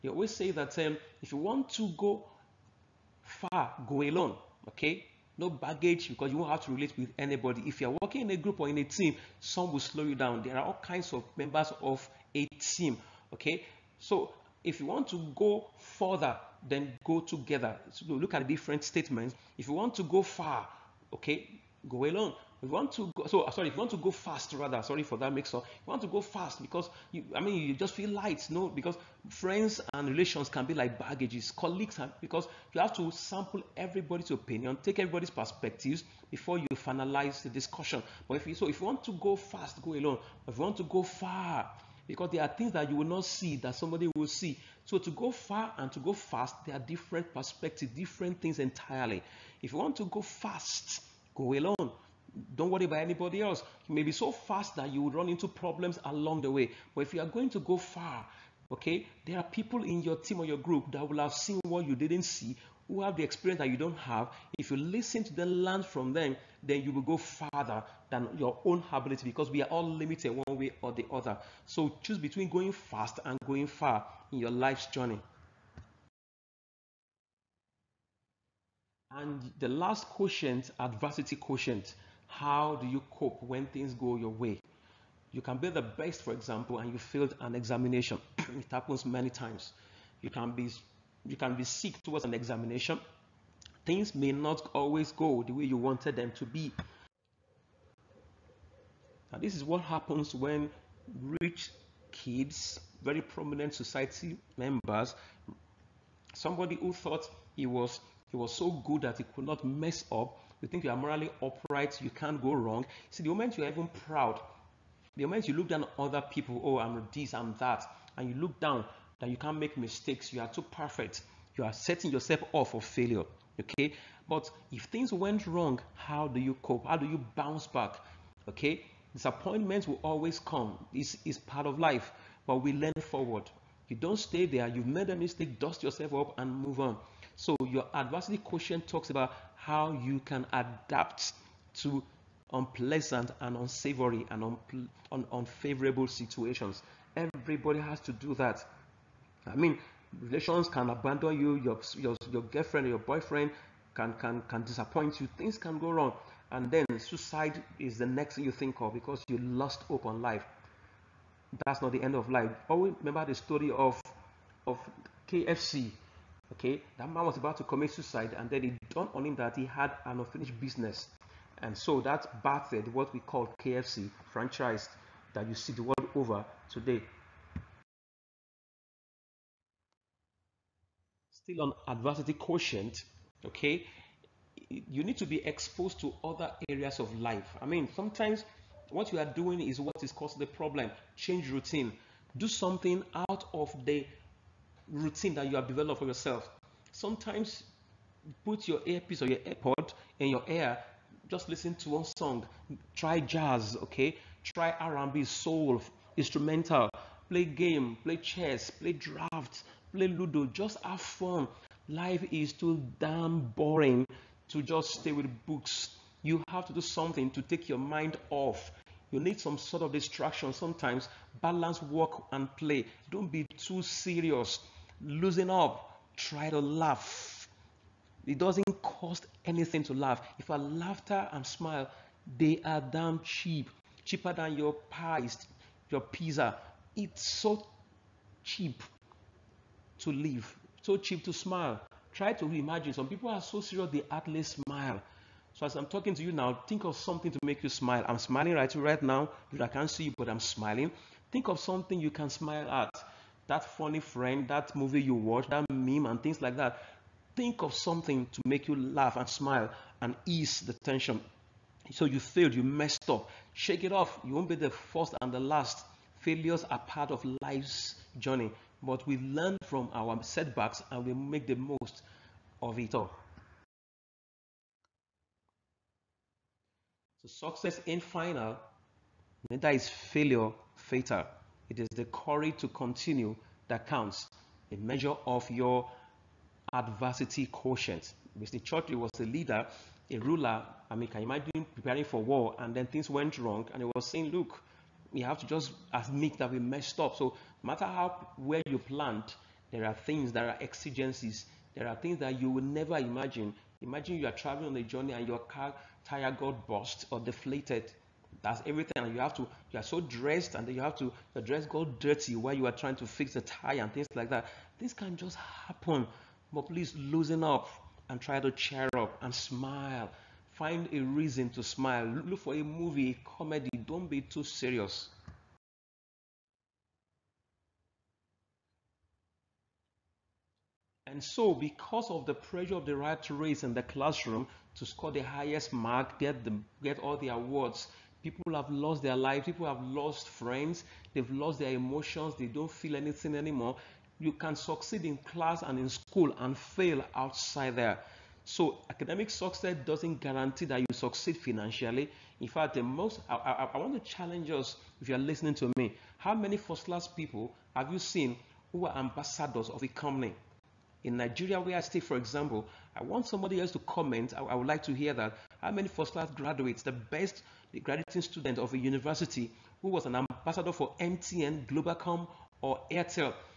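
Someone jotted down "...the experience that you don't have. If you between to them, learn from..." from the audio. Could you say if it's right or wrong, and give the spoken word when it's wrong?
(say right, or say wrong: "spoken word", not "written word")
wrong: "listen", not "between".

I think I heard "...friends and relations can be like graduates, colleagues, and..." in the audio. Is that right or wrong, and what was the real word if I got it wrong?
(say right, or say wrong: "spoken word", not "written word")
wrong: "baggages", not "graduates".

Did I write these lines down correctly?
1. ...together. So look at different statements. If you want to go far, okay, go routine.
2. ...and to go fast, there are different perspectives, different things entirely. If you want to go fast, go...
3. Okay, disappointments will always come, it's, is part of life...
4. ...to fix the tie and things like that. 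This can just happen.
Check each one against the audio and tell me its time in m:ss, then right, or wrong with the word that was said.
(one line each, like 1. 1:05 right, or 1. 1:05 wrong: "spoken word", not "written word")
1. 0:17 wrong: "alone", not "routine"
2. 0:45 right
3. 2:08 right
4. 5:12 right.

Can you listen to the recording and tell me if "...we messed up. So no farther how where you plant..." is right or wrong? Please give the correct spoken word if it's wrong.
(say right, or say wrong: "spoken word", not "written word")
wrong: "matter", not "farther".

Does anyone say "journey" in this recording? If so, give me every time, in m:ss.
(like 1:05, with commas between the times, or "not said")
1:14, 4:28, 5:04.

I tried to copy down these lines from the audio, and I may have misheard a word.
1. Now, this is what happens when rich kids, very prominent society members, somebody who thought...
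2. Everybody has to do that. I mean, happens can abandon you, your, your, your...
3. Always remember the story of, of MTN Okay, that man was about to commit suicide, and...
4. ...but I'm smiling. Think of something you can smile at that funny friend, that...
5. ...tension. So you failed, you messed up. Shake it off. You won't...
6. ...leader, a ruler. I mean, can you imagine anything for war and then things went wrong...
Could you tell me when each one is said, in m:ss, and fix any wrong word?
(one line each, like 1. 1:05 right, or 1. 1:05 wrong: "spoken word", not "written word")
1. 1:39 right
2. 2:27 wrong: "relations", not "happens"
3. 2:42 wrong: "KFC", not "MTN"
4. 4:10 right
5. 4:20 right
6. 4:49 wrong: "preparing", not "anything".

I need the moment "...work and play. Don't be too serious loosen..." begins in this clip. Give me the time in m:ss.
3:41.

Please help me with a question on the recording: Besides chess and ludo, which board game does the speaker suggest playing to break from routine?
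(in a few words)
Draft.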